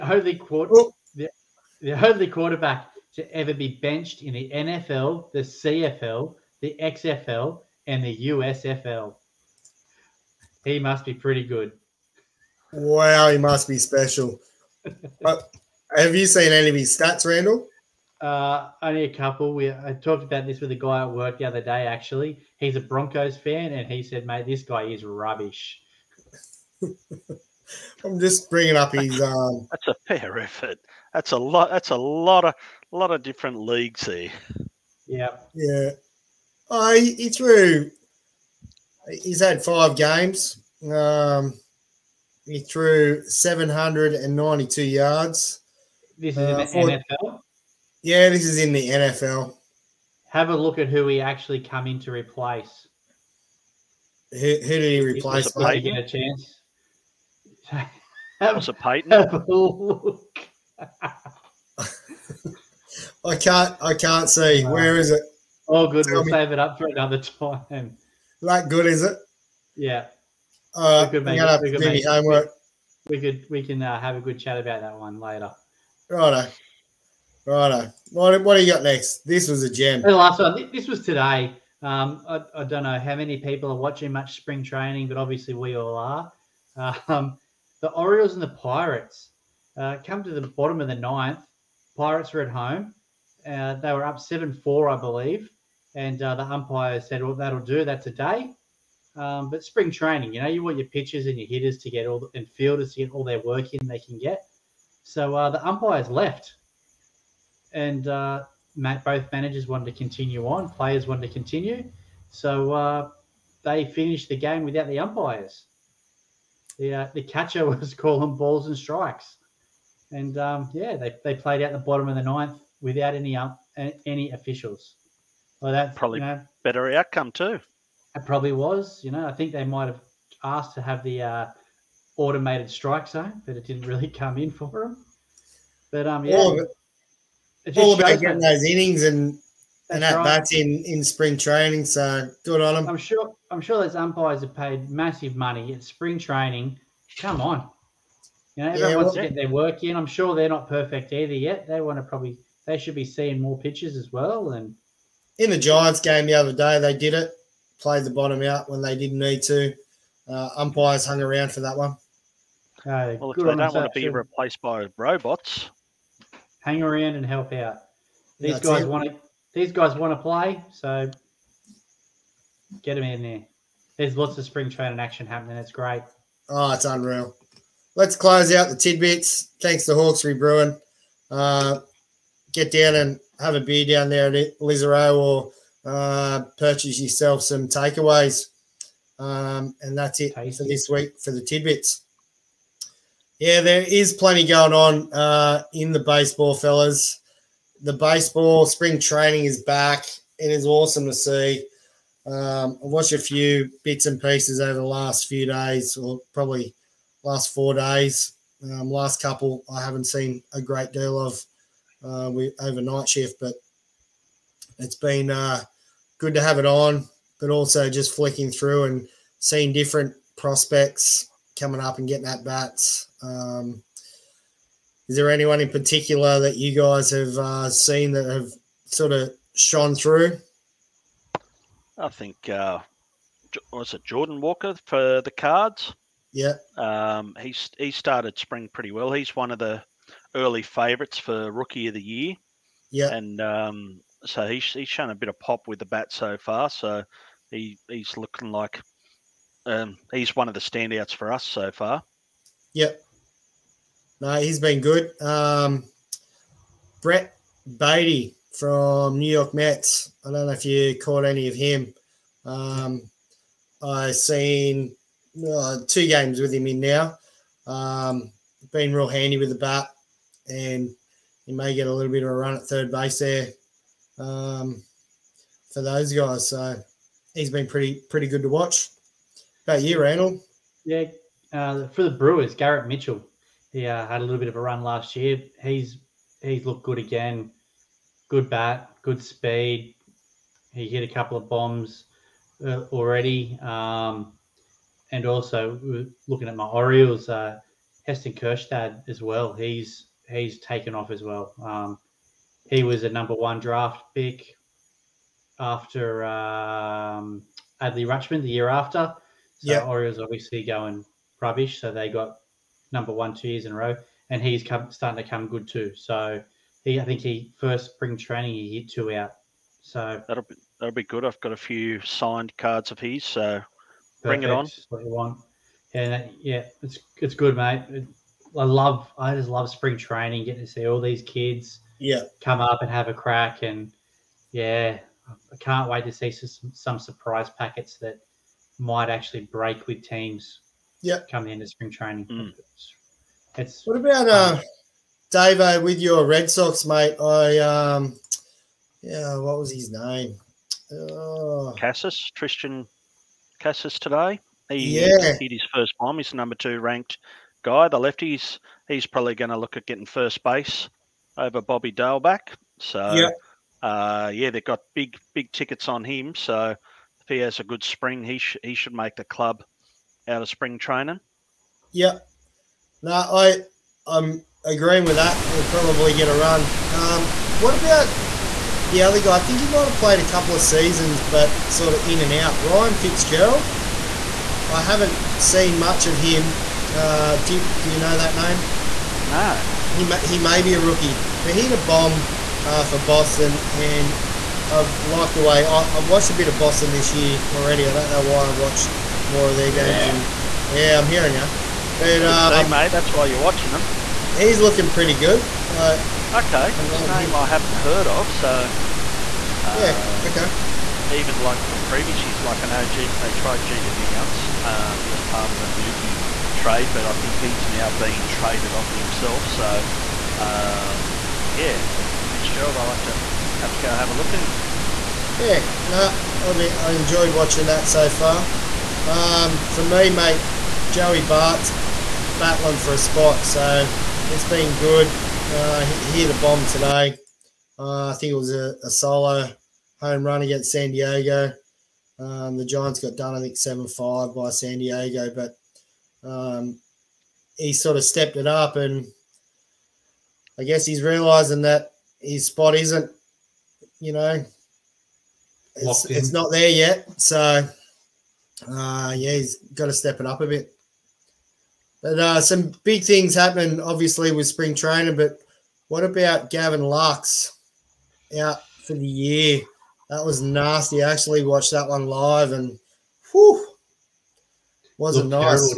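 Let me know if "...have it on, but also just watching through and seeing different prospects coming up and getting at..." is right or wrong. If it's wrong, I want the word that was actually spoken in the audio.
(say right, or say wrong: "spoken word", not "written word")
wrong: "flicking", not "watching".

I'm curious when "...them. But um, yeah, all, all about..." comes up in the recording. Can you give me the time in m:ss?
2:14.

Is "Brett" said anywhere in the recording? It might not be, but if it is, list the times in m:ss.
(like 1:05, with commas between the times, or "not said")
4:17.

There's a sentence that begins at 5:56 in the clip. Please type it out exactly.
He's number two ranked guy, the lefties, he's probably going to look at getting first base over Bobby Dalbec.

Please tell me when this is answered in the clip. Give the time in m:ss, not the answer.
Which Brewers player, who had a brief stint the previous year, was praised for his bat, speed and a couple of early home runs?
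4:42.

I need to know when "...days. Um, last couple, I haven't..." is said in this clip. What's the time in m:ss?
3:27.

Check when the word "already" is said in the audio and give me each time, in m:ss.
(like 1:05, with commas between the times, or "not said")
4:52, 6:37.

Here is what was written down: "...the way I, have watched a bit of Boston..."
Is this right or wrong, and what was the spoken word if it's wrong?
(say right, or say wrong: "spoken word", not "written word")
right.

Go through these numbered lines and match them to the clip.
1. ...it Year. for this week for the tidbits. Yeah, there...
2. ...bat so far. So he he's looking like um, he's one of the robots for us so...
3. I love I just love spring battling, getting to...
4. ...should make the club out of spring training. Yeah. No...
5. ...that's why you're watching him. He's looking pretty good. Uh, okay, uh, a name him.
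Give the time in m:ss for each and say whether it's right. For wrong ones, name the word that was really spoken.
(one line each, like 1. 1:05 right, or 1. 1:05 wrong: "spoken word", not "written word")
1. 3:10 wrong: "Tasty", not "Year"
2. 4:05 wrong: "standouts", not "robots"
3. 5:28 wrong: "training", not "battling"
4. 6:08 right
5. 6:42 right.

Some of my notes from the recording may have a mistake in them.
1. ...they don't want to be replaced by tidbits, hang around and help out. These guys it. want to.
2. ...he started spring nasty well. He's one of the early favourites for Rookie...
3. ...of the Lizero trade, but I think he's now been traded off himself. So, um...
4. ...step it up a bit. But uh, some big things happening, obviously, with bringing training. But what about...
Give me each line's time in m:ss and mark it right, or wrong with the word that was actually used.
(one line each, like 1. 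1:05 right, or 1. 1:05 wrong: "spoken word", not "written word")
1. 2:43 wrong: "robots", not "tidbits"
2. 3:57 wrong: "pretty", not "nasty"
3. 6:55 wrong: "Mookie", not "Lizero"
4. 7:39 wrong: "spring", not "bringing".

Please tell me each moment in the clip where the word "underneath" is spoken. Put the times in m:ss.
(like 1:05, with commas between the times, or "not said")
not said.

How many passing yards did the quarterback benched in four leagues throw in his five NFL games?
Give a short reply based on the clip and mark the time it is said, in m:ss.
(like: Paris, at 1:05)
792, at 0:43.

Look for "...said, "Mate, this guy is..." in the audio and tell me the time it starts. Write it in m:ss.
0:24.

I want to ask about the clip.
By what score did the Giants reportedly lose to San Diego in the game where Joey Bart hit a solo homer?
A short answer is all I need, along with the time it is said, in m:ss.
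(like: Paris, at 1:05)
7-5, at 7:23.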